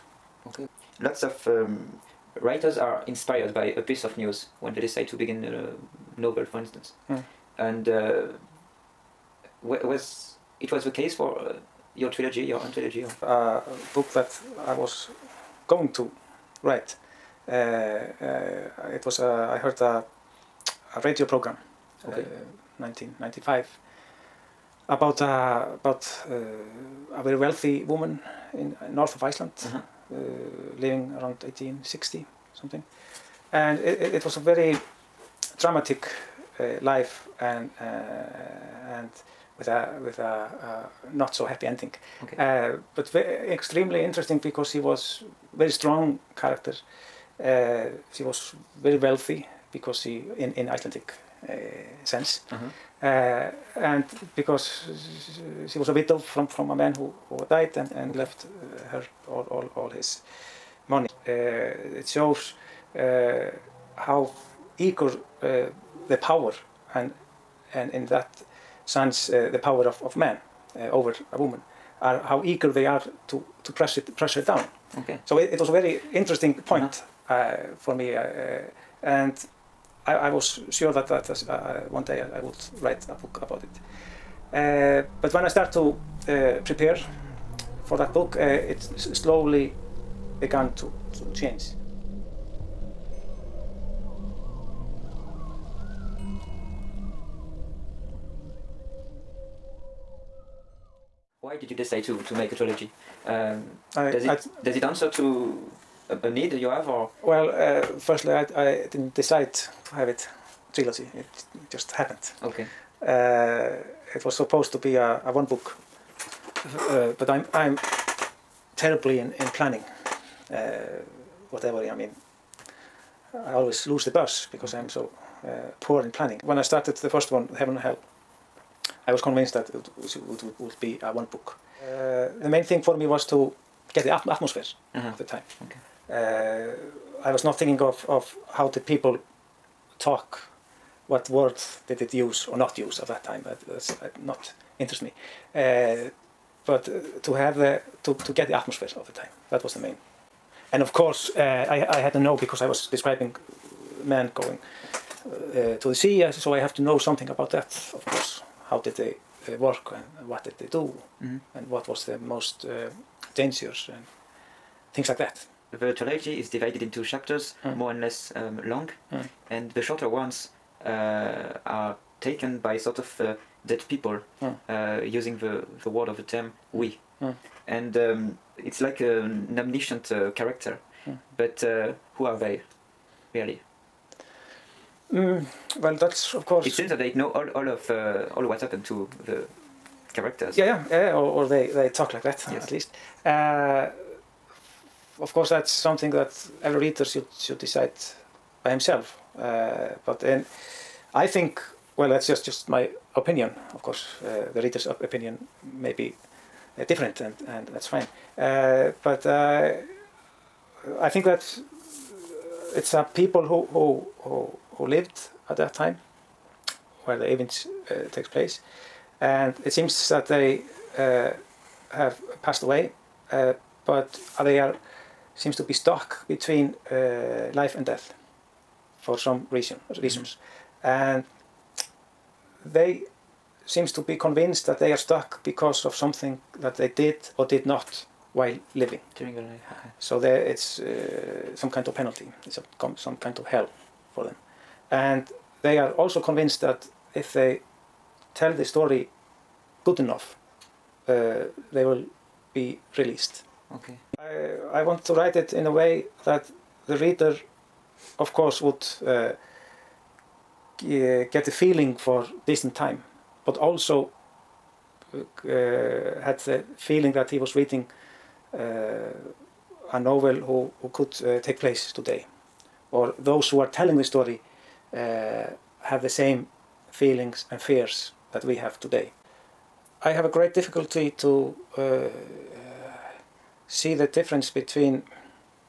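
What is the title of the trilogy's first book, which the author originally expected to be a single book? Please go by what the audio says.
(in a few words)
Heaven and Hell.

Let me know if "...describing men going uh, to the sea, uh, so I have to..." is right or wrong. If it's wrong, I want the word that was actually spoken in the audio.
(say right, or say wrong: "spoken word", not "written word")
right.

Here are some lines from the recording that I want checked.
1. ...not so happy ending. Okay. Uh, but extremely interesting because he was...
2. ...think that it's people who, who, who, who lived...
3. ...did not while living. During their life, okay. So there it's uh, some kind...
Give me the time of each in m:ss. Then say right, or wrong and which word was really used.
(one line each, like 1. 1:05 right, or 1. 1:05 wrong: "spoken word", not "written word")
1. 0:41 right
2. 3:31 right
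3. 3:57 right.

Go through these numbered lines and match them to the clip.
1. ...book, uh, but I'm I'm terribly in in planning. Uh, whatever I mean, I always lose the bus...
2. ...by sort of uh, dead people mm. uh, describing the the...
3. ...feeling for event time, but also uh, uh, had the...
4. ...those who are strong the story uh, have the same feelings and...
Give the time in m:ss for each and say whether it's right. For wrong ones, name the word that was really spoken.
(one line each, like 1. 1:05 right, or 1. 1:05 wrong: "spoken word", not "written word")
1. 1:55 right
2. 2:52 wrong: "using", not "describing"
3. 4:21 wrong: "distant", not "event"
4. 4:33 wrong: "telling", not "strong".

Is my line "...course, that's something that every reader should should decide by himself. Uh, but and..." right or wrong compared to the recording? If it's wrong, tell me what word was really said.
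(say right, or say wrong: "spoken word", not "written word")
right.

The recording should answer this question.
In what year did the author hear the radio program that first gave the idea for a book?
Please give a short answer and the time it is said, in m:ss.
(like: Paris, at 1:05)
1995, at 0:22.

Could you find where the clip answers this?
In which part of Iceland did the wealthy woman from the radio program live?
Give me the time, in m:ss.
0:28.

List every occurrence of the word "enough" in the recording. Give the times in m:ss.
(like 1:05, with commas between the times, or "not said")
4:09.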